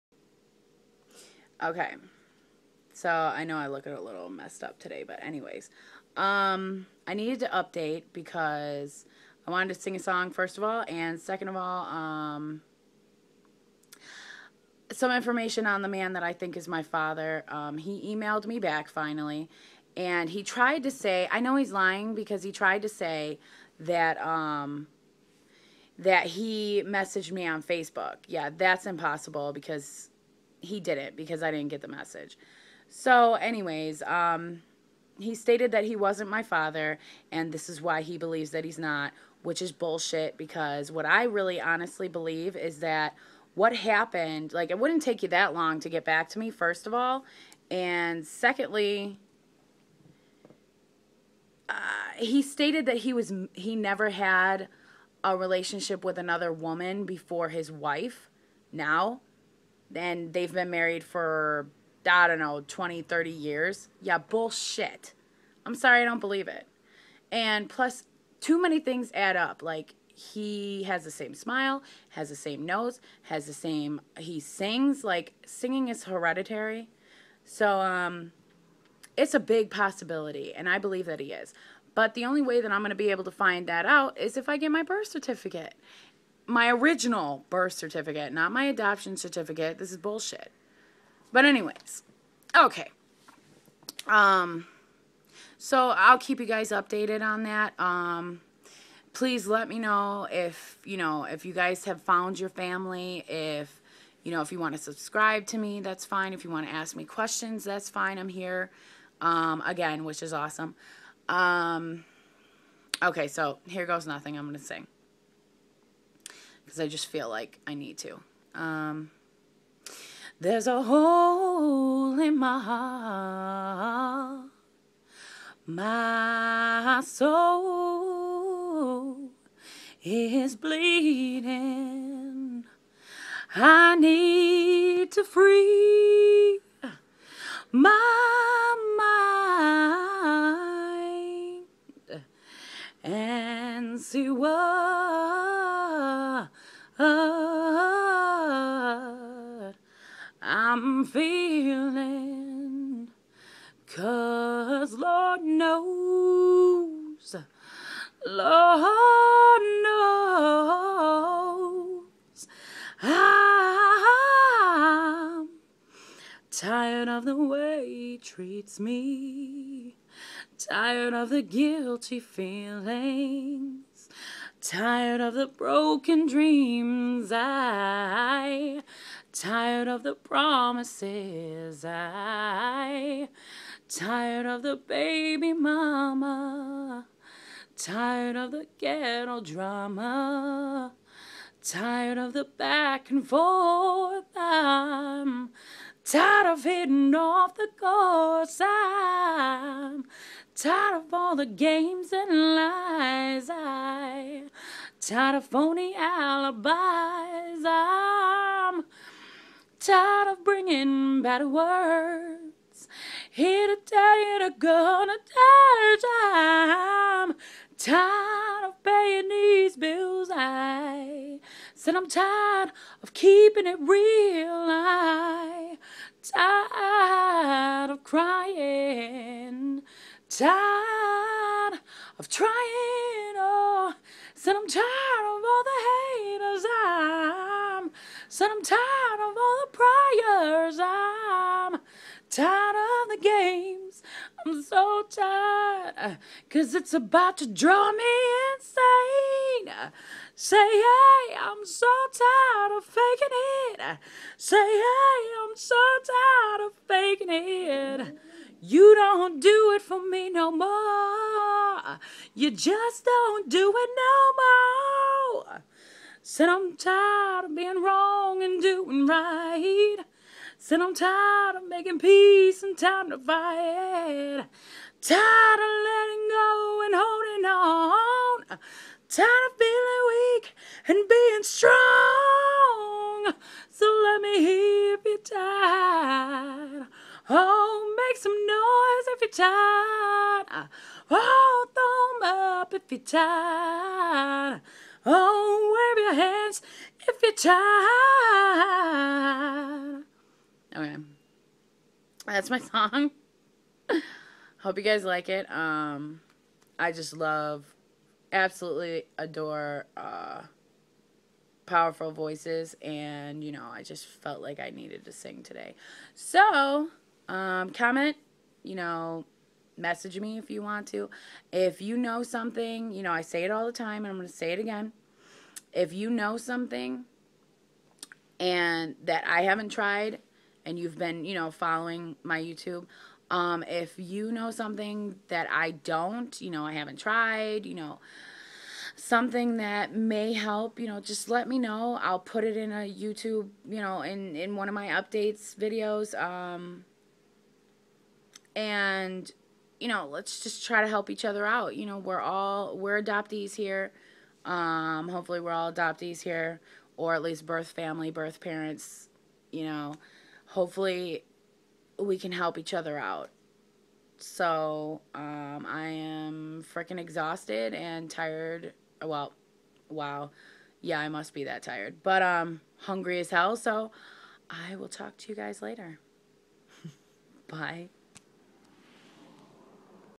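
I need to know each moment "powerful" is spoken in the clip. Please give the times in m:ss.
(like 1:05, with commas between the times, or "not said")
5:11.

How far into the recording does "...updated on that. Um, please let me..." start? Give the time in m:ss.
1:36.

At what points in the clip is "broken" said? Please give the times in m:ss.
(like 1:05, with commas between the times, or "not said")
2:55.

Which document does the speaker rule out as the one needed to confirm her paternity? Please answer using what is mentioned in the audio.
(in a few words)
adoption certificate.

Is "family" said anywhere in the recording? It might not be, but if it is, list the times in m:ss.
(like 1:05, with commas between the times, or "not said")
1:42, 5:57.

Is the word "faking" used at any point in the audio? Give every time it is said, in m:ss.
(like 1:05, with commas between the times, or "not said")
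4:12, 4:16.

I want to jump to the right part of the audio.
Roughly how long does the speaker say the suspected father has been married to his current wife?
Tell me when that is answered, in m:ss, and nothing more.
1:02.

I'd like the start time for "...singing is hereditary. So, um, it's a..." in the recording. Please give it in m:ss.
1:15.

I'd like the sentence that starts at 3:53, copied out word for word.
Oh, said I'm tired of all the haters.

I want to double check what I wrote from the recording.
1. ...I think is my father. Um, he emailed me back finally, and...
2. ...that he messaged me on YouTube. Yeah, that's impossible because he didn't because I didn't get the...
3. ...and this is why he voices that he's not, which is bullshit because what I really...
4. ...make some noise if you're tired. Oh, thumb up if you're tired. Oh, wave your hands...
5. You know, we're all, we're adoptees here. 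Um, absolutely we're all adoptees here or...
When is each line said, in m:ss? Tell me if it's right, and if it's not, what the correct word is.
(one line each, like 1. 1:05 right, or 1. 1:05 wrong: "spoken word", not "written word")
1. 0:16 right
2. 0:25 wrong: "Facebook", not "YouTube"
3. 0:37 wrong: "believes", not "voices"
4. 4:47 right
5. 5:51 wrong: "hopefully", not "absolutely".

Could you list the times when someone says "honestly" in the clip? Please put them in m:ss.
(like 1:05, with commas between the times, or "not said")
0:41.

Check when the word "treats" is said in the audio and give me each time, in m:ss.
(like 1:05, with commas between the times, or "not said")
2:48.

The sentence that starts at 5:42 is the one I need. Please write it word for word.
I'll put it in a YouTube, you know, in, in one of my updates videos.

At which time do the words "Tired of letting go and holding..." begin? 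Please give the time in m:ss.
4:35.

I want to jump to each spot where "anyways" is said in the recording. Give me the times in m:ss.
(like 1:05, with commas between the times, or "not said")
0:05, 0:33, 1:31.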